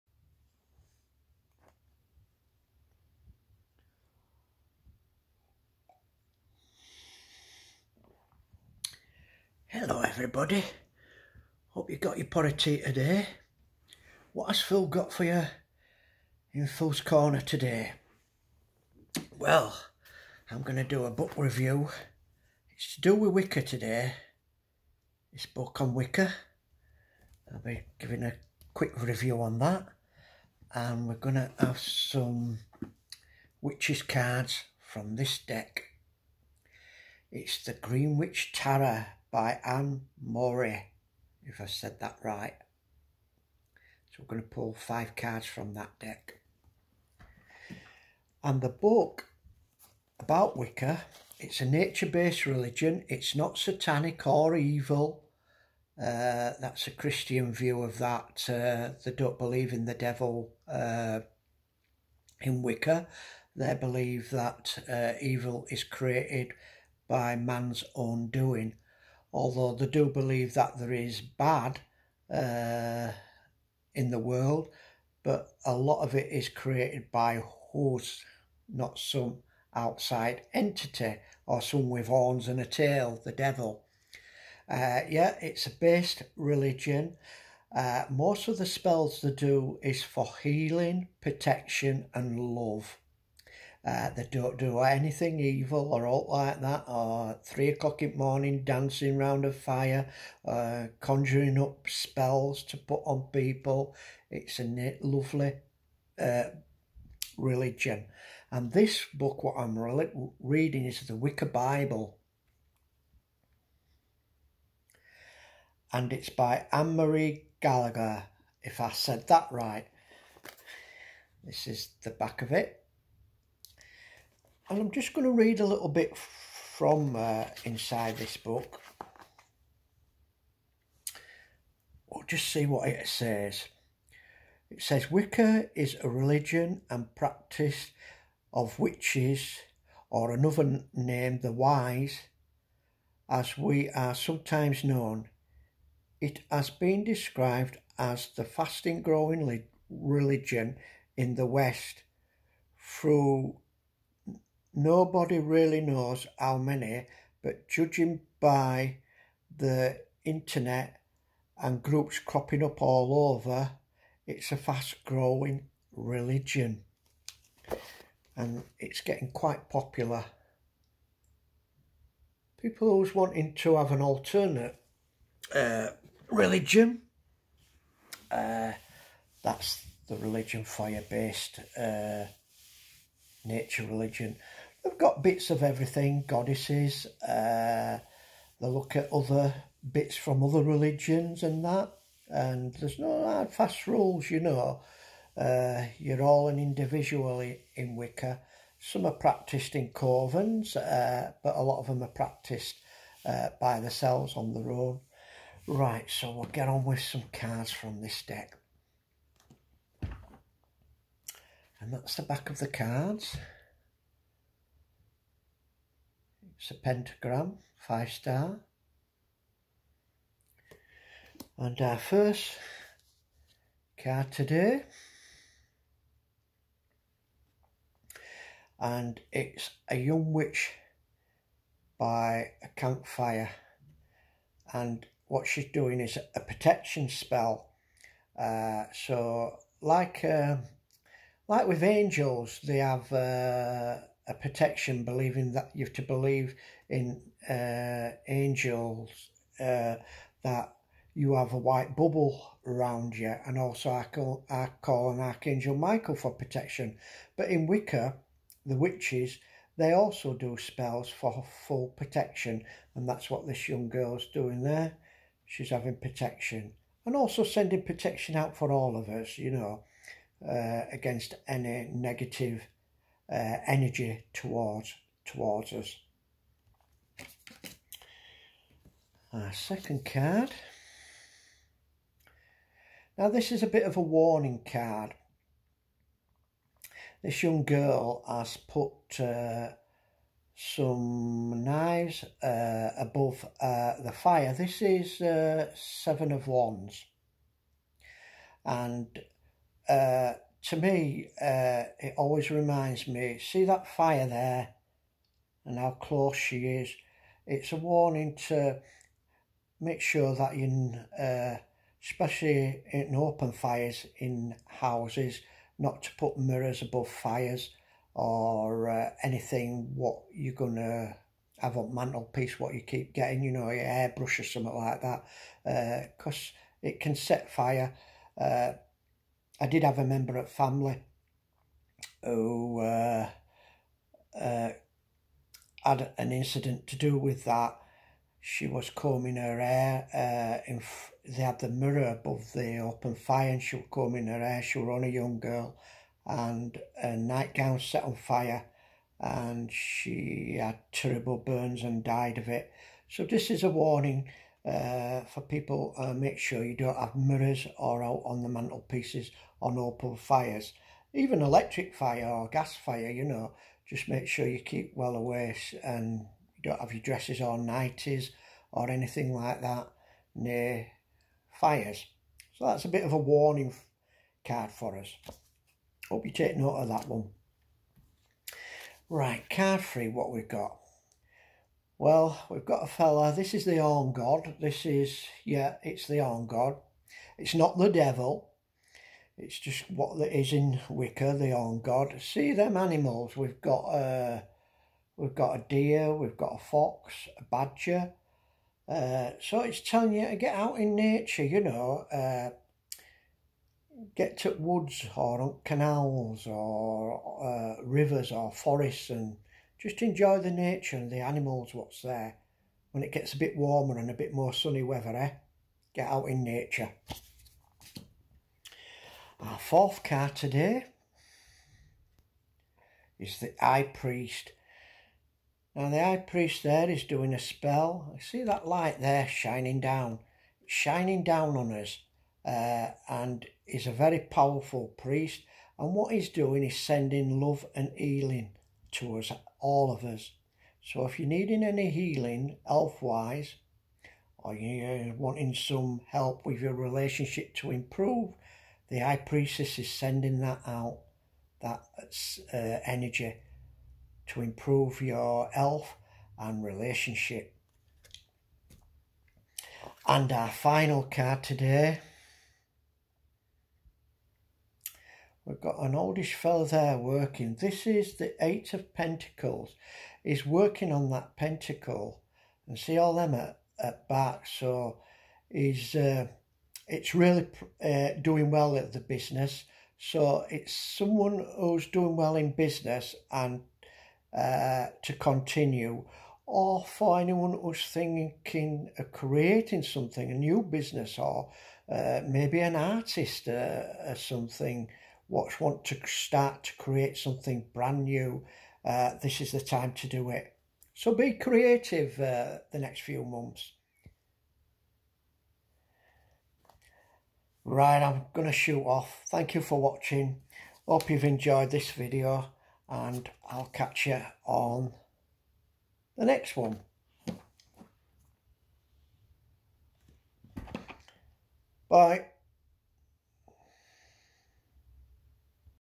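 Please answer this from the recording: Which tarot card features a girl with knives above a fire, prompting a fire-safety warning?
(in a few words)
Seven of Wands.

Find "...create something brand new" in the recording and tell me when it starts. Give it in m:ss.
8:16.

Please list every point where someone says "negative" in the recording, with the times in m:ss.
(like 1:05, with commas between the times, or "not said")
4:31.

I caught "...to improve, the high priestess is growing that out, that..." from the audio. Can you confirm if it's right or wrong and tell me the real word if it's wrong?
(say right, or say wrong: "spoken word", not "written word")
wrong: "sending", not "growing".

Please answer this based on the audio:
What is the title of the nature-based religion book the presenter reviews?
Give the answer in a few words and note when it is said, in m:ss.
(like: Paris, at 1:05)
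The Wicca Bible, at 1:51.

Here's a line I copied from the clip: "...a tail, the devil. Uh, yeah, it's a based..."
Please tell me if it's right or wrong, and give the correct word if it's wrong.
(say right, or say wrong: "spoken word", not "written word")
right.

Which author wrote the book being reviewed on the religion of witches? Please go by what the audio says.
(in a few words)
Anne Marie Gallagher.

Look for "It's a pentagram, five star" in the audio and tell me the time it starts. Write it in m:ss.
3:36.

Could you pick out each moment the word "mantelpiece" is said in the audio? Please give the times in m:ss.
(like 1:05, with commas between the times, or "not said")
5:21, 5:58.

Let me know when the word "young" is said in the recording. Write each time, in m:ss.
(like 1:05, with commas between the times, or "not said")
3:49, 4:23, 4:47, 5:45.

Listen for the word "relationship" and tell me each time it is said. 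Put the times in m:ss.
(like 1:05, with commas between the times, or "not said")
7:26, 7:36.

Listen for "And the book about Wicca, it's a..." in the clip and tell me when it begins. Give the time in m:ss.
0:48.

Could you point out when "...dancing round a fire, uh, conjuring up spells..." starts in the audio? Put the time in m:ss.
1:38.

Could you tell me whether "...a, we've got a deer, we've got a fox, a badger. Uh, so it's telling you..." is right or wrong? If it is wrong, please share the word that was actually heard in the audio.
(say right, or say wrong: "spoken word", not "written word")
right.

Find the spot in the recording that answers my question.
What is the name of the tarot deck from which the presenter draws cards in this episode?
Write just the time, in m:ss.
0:37.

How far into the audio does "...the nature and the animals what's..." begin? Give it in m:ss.
6:50.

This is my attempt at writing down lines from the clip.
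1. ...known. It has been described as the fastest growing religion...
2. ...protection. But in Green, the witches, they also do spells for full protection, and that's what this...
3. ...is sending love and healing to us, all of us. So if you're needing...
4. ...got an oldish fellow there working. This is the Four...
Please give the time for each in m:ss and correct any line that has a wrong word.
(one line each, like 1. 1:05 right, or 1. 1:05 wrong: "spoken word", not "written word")
1. 2:24 right
2. 4:16 wrong: "Wicca", not "Green"
3. 7:16 right
4. 7:45 wrong: "Eight", not "Four".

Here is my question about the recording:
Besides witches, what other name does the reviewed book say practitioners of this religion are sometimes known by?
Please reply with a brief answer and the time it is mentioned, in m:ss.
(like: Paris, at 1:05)
the wise, at 2:21.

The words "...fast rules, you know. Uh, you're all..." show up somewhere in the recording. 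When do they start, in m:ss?
3:13.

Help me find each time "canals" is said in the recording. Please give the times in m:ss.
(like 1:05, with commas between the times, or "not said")
6:45.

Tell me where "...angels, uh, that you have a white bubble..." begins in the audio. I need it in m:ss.
4:08.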